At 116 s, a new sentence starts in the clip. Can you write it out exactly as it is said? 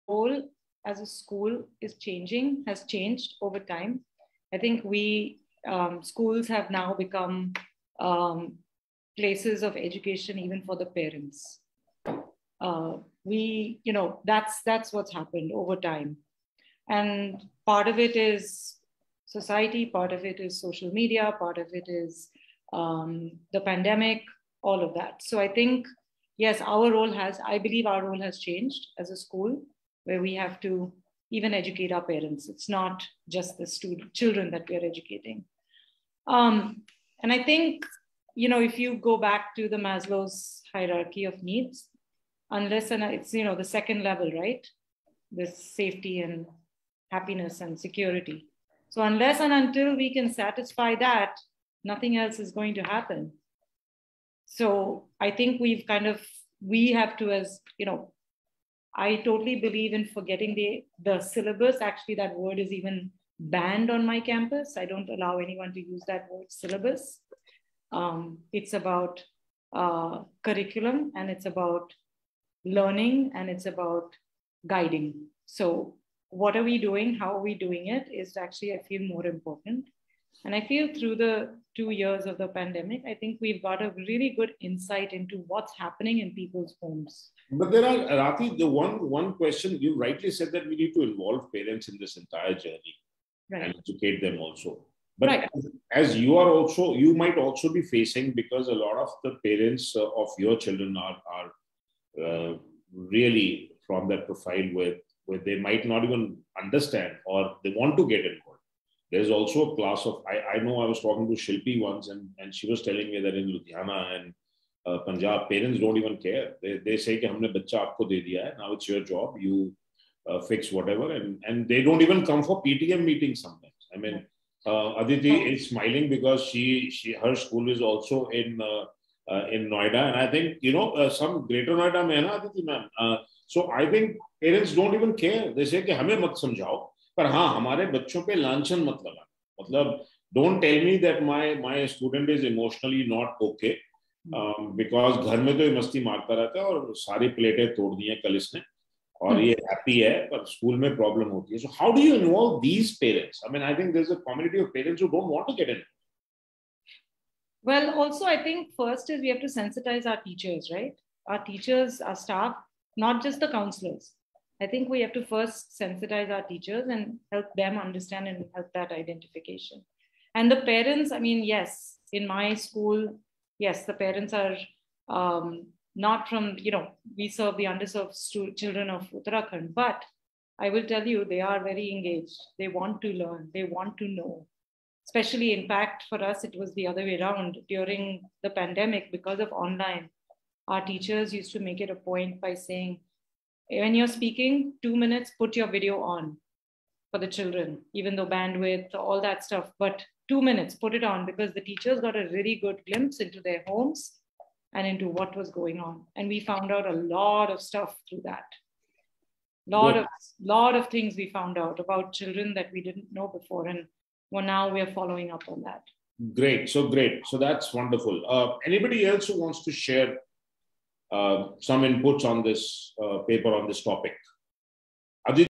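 They, they say that humne bacha aapko de diya hai.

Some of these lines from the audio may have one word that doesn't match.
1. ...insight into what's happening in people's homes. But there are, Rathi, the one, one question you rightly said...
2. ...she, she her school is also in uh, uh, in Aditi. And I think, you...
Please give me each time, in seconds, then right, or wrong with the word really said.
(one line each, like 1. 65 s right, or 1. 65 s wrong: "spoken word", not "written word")
1. 84 s right
2. 126 s wrong: "Noida", not "Aditi".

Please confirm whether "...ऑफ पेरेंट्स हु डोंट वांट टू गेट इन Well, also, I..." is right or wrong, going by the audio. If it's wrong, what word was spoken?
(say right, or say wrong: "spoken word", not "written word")
right.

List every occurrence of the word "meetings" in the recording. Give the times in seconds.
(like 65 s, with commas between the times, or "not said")
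123 s.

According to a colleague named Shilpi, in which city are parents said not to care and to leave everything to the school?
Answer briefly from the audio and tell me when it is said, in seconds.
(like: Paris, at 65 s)
Ludhiana, at 113 s.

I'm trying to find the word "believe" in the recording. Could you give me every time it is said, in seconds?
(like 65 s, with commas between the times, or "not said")
27 s, 59 s.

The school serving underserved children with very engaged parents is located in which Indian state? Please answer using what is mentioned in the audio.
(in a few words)
Uttarakhand.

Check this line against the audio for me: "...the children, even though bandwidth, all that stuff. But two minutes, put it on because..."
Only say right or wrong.
right.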